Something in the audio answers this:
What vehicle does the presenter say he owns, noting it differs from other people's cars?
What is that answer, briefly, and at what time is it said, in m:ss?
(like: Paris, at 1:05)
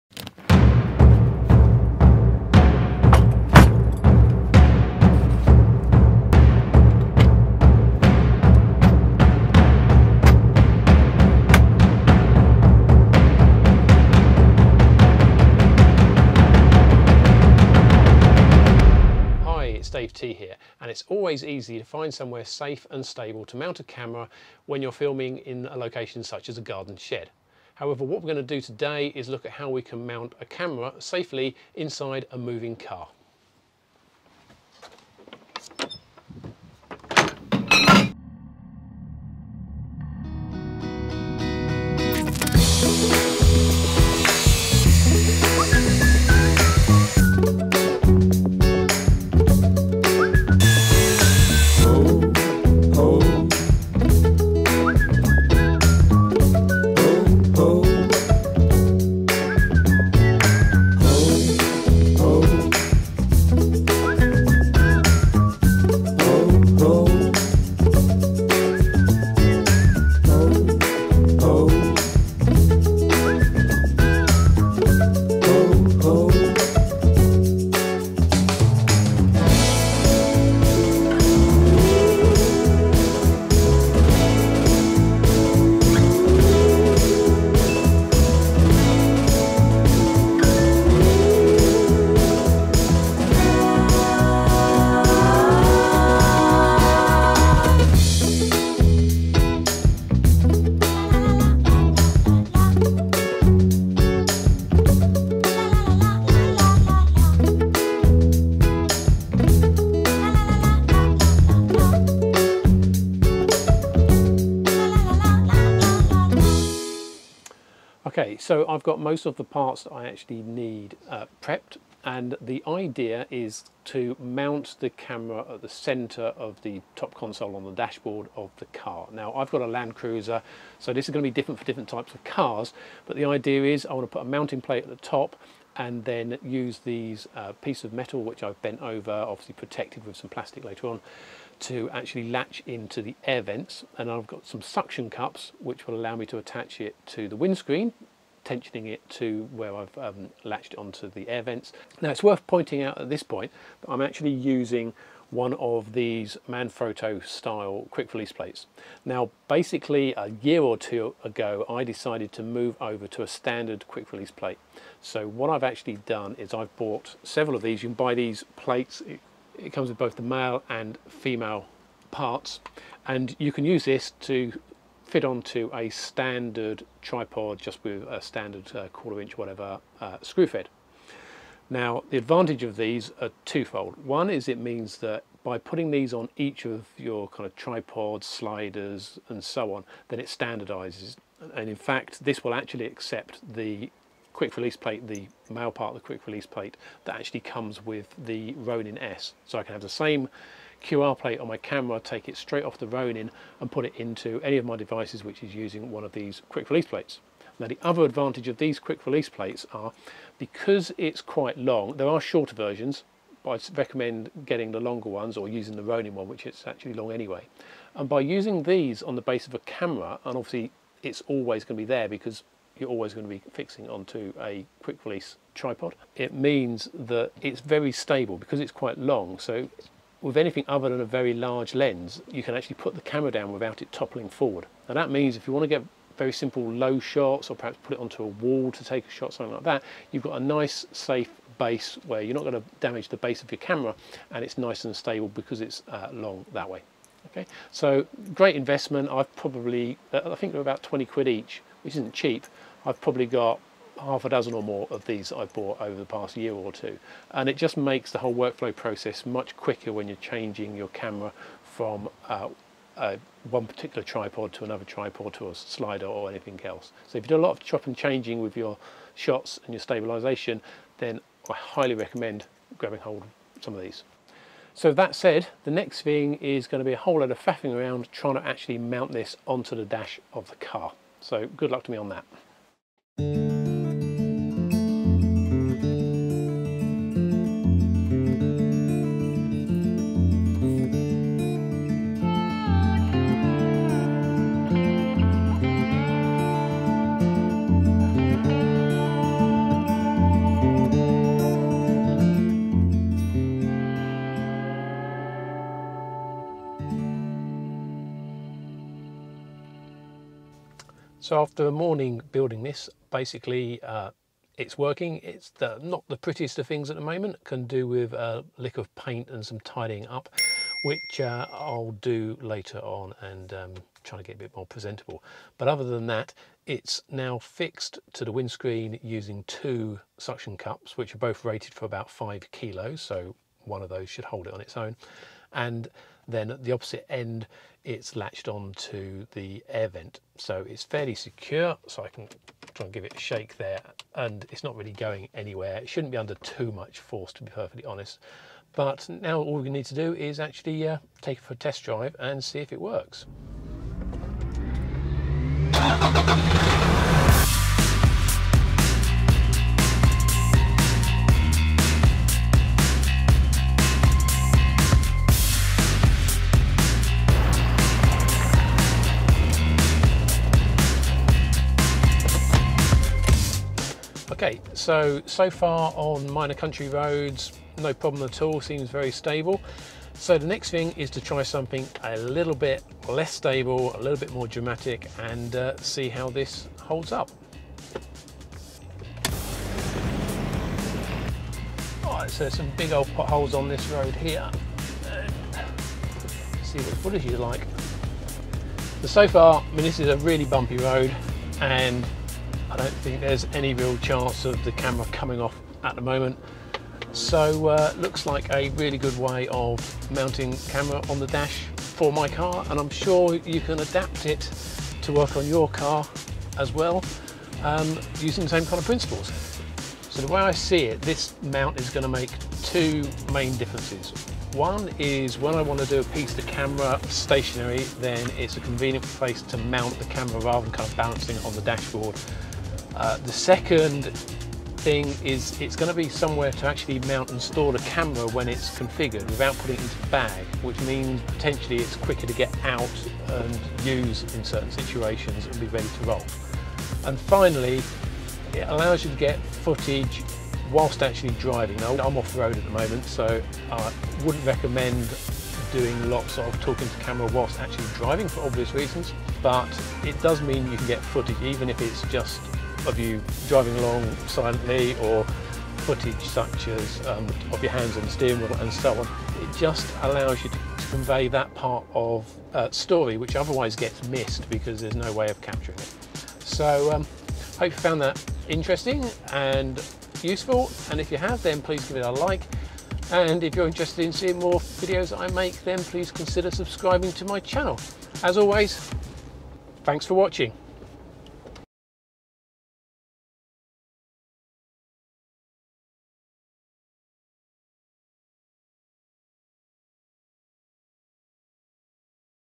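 Land Cruiser, at 2:09.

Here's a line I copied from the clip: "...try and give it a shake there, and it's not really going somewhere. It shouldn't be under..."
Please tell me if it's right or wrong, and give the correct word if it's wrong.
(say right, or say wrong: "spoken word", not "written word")
wrong: "anywhere", not "somewhere".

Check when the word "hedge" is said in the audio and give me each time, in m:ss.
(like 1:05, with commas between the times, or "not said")
not said.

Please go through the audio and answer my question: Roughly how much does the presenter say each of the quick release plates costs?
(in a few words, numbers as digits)
£20.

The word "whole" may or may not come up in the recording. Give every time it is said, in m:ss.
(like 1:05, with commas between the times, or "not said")
4:18, 4:36.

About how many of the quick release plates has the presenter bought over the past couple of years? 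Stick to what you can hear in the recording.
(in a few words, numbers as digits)
half a dozen.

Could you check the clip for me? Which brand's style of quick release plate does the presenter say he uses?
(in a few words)
Manfrotto.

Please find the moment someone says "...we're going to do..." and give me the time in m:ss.
0:28.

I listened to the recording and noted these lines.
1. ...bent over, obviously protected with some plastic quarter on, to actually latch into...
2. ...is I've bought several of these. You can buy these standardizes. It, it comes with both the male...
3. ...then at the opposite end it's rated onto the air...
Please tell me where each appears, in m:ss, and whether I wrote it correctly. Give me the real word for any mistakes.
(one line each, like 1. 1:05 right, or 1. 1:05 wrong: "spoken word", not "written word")
1. 2:18 wrong: "later", not "quarter"
2. 2:46 wrong: "plates", not "standardizes"
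3. 5:36 wrong: "latched", not "rated".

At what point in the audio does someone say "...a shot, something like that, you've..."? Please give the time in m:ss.
3:59.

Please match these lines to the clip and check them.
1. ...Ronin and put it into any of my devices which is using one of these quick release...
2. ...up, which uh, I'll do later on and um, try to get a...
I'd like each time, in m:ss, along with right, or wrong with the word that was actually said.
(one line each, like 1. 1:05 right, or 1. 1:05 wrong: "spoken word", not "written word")
1. 3:22 right
2. 5:20 right.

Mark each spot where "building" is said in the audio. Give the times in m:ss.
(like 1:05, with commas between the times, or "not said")
5:12.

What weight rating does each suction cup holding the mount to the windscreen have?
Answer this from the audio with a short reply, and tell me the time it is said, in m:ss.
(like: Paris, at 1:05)
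5 kilos, at 5:32.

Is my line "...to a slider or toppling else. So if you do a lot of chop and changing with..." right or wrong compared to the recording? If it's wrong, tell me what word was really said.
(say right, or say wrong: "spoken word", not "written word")
wrong: "anything", not "toppling".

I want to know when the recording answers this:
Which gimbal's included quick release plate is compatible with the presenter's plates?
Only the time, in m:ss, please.
3:18.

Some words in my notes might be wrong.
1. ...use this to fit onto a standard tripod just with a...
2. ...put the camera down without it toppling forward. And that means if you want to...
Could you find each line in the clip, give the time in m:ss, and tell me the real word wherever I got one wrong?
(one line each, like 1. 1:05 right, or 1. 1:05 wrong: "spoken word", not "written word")
1. 2:53 right
2. 3:52 right.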